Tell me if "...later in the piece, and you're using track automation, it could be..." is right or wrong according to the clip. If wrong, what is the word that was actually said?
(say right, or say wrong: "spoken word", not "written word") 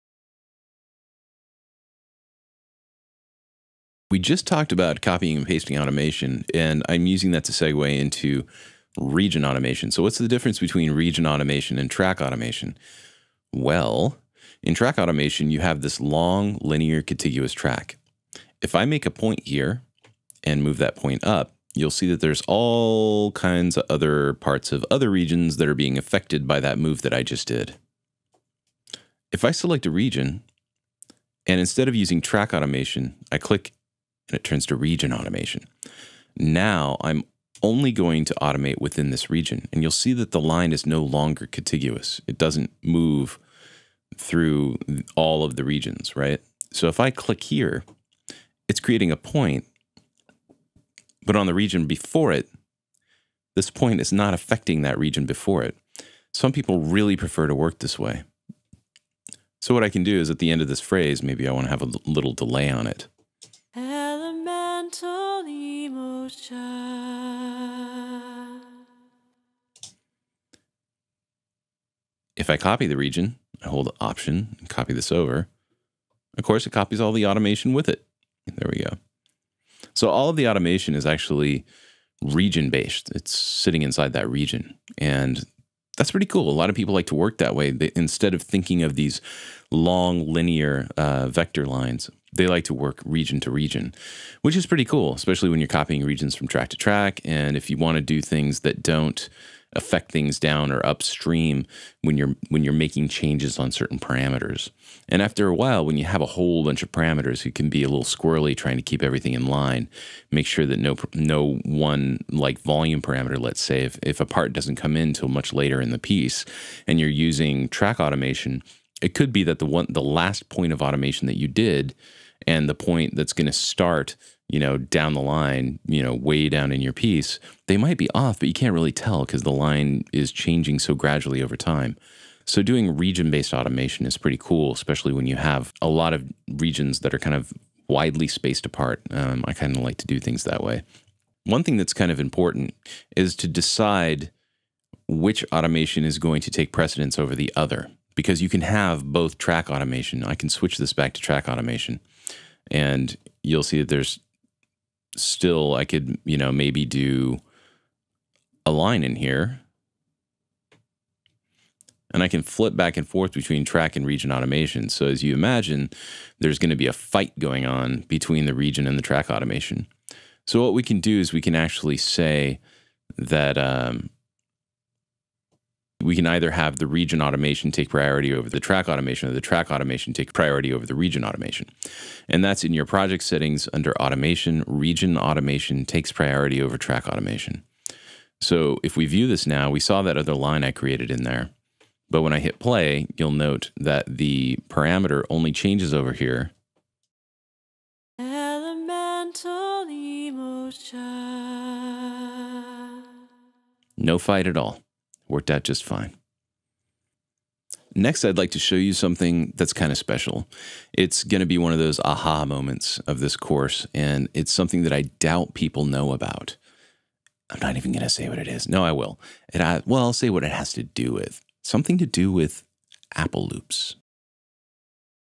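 right.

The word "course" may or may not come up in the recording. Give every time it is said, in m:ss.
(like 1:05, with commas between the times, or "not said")
1:16, 3:33.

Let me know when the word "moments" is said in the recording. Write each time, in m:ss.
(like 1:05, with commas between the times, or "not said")
3:32.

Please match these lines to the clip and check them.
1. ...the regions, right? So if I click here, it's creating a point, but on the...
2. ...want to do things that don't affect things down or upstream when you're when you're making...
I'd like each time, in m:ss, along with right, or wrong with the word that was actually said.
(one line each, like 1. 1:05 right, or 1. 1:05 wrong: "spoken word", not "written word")
1. 0:45 right
2. 1:37 right.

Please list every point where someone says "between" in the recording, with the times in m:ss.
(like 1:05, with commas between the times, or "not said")
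0:10, 2:43, 2:48.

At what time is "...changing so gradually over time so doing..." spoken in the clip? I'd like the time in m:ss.
2:10.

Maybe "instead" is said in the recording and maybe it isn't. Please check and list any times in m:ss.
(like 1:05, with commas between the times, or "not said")
0:31, 1:27.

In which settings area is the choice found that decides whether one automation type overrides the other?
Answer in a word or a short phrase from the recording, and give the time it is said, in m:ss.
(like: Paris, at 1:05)
project settings, at 3:02.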